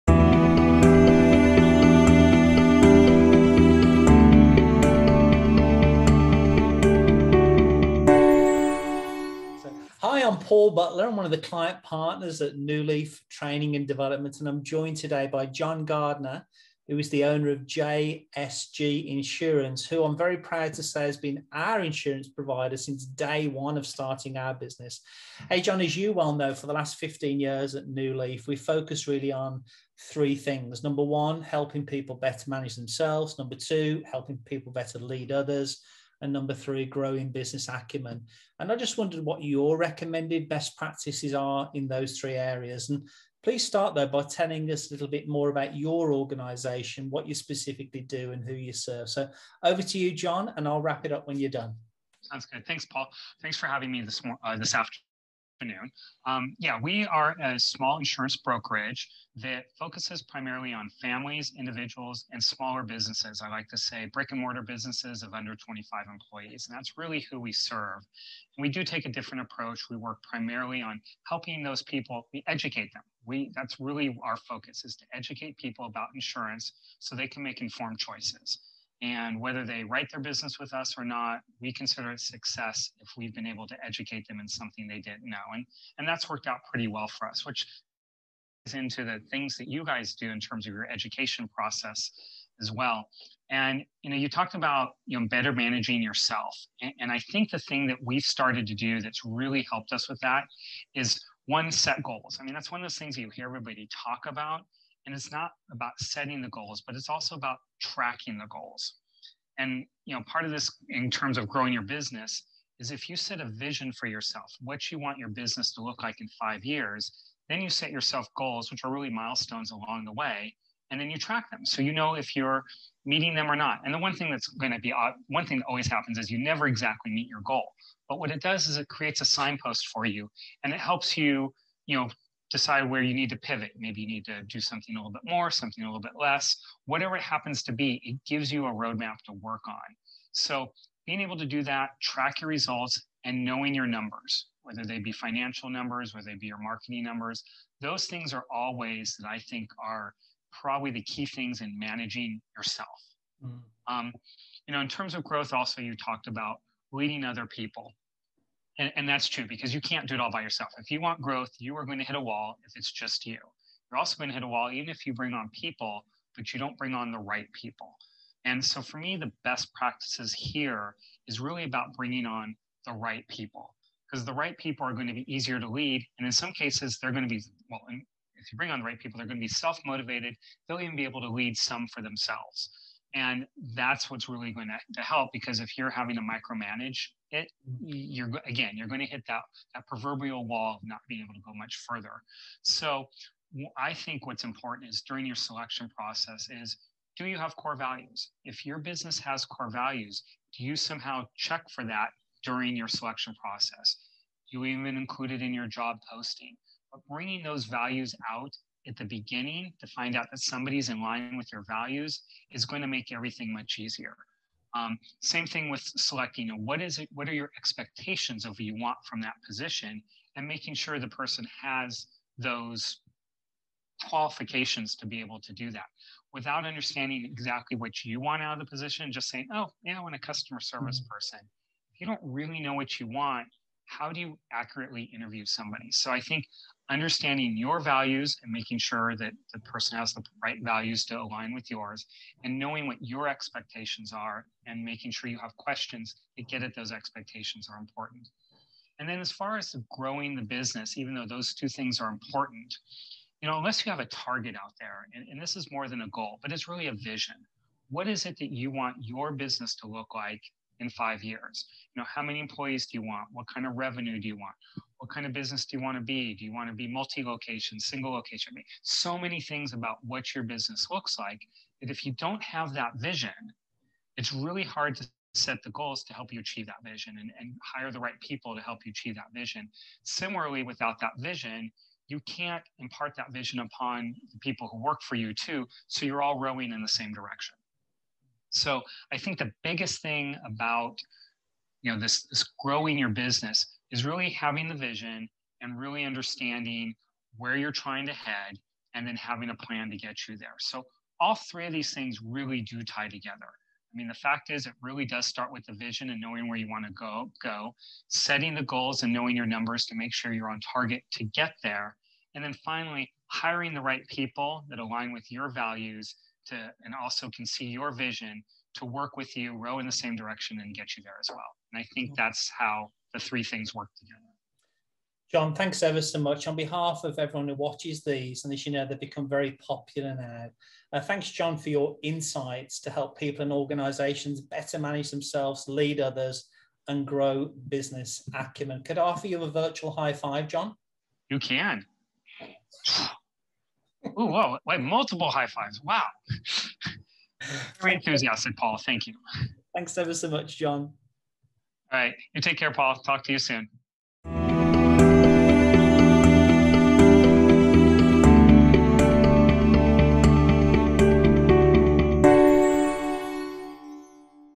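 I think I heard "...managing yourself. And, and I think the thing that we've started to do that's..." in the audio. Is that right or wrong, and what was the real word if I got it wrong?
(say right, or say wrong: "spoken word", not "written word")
right.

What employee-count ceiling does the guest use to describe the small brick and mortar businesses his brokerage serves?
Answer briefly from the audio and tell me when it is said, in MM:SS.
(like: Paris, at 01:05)
under 25 employees, at 01:05.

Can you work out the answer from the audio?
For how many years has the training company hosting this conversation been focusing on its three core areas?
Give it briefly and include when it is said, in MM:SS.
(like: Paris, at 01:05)
15, at 00:26.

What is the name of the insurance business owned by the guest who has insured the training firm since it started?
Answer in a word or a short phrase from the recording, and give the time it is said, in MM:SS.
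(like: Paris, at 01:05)
JSG Insurance, at 00:17.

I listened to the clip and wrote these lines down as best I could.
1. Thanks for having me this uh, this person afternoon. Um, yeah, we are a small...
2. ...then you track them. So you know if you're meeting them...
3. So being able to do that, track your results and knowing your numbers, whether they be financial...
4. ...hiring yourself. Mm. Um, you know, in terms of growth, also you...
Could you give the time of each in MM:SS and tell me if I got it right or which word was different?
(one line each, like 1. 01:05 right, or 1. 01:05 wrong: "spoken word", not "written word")
1. 00:53 wrong: "afternoon", not "person"
2. 02:00 right
3. 02:20 right
4. 02:31 wrong: "managing", not "hiring".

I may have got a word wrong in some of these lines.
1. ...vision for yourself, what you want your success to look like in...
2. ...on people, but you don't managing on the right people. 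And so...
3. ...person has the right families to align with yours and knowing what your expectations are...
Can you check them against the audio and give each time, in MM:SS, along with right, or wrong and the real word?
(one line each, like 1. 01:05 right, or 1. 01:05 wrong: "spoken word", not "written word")
1. 01:53 wrong: "business", not "success"
2. 02:45 wrong: "bring", not "managing"
3. 03:59 wrong: "values", not "families".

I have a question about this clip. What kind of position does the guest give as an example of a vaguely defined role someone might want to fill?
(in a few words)
customer service.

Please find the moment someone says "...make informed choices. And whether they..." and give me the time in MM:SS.
01:17.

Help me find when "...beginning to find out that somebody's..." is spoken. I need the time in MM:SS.
03:29.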